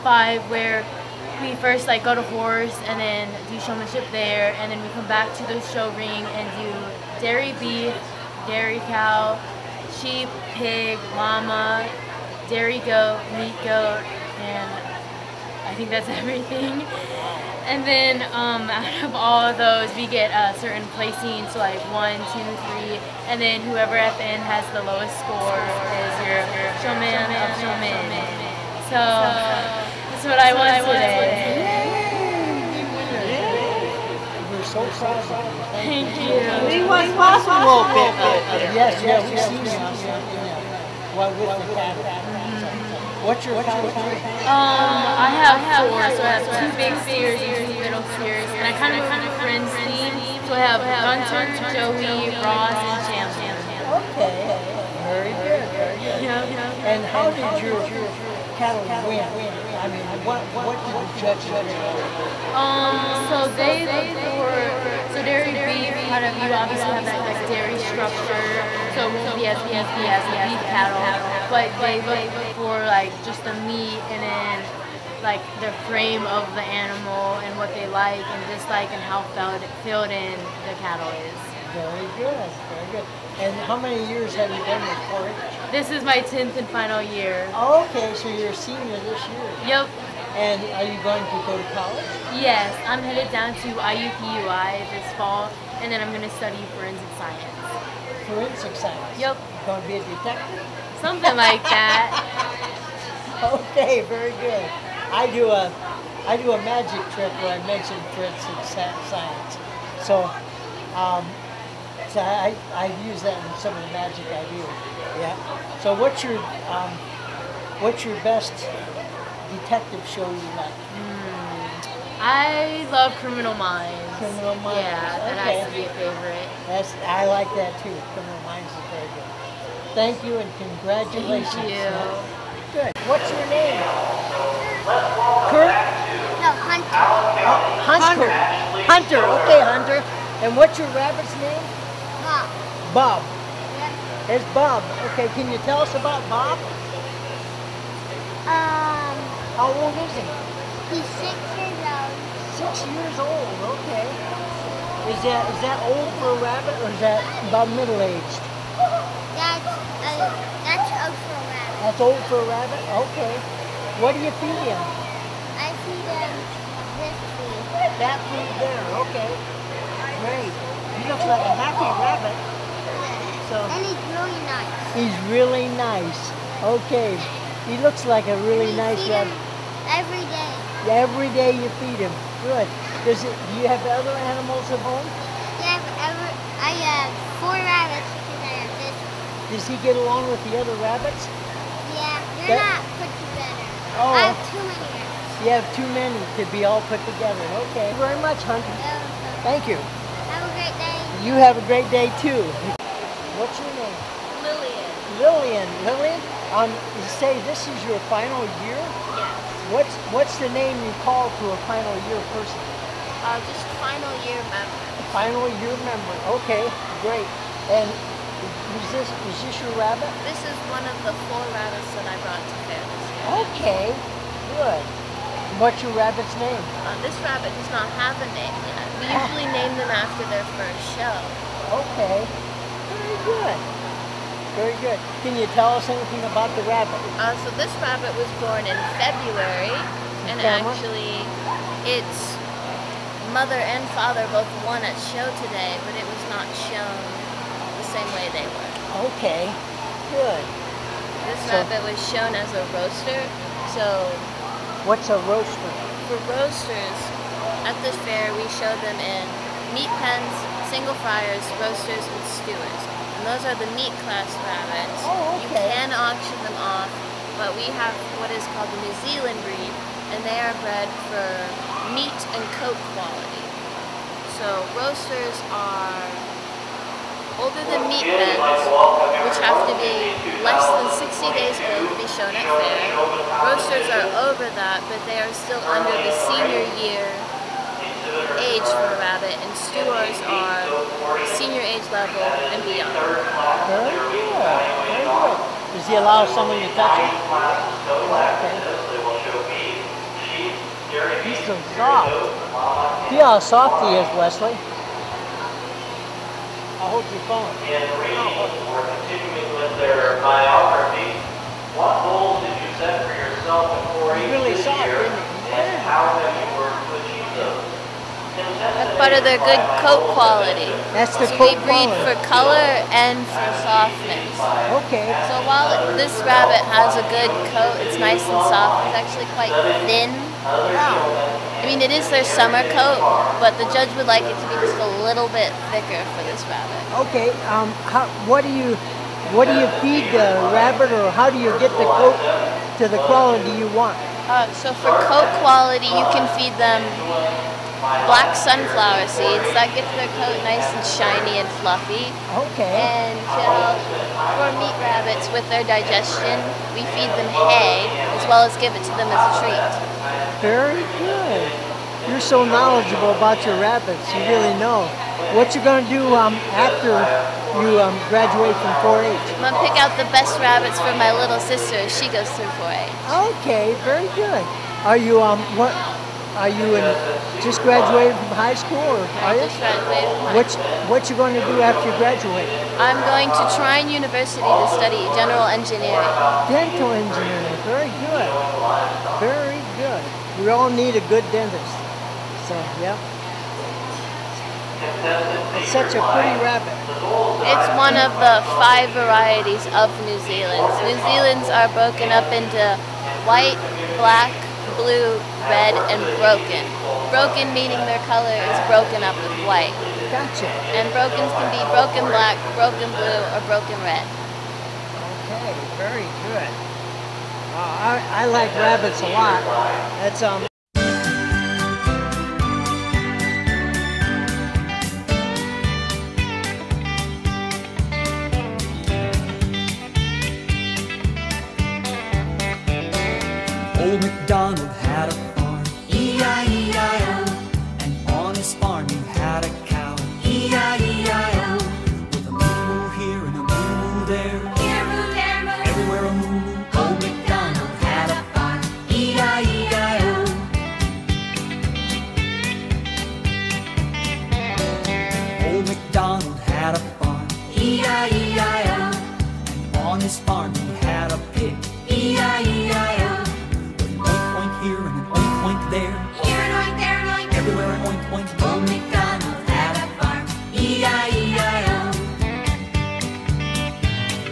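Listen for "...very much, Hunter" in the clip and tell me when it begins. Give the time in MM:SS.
03:18.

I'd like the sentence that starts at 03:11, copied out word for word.
Yeah, they're that, not put together.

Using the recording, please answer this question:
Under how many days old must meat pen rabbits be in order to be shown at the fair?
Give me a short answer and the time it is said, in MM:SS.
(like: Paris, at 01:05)
60, at 04:41.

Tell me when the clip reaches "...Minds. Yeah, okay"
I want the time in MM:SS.
02:04.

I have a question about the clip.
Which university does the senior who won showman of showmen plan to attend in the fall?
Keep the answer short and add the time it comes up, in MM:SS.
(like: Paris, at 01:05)
IUPUI, at 01:33.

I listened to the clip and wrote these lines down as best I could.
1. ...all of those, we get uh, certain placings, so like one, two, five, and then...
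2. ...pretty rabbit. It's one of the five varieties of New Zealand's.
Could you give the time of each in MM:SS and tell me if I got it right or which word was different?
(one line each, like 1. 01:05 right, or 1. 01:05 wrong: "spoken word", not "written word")
1. 00:19 wrong: "three", not "five"
2. 06:36 right.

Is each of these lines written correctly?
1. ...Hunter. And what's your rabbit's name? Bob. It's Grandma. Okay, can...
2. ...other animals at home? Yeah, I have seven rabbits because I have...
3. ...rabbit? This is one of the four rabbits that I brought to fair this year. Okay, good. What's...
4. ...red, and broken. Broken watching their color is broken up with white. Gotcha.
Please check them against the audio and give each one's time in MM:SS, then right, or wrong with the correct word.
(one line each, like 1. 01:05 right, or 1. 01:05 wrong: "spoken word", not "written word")
1. 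02:19 wrong: "Bob", not "Grandma"
2. 03:03 wrong: "four", not "seven"
3. 03:39 right
4. 06:45 wrong: "meaning", not "watching".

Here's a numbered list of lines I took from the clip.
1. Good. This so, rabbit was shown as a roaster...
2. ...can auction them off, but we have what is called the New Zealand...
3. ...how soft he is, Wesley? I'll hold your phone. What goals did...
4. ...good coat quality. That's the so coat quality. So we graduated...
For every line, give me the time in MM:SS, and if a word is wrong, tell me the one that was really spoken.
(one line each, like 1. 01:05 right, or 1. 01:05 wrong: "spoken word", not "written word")
1. 04:10 right
2. 04:25 right
3. 05:03 right
4. 05:19 wrong: "breed", not "graduated".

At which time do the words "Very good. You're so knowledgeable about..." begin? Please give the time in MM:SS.
06:00.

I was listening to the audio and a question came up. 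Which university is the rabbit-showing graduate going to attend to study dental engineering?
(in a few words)
Trine University.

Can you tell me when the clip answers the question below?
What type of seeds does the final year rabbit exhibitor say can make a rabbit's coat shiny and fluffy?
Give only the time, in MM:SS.
05:48.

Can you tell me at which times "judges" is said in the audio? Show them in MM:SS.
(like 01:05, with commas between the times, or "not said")
01:01, 05:33.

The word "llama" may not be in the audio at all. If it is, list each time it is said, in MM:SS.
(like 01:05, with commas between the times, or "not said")
00:11.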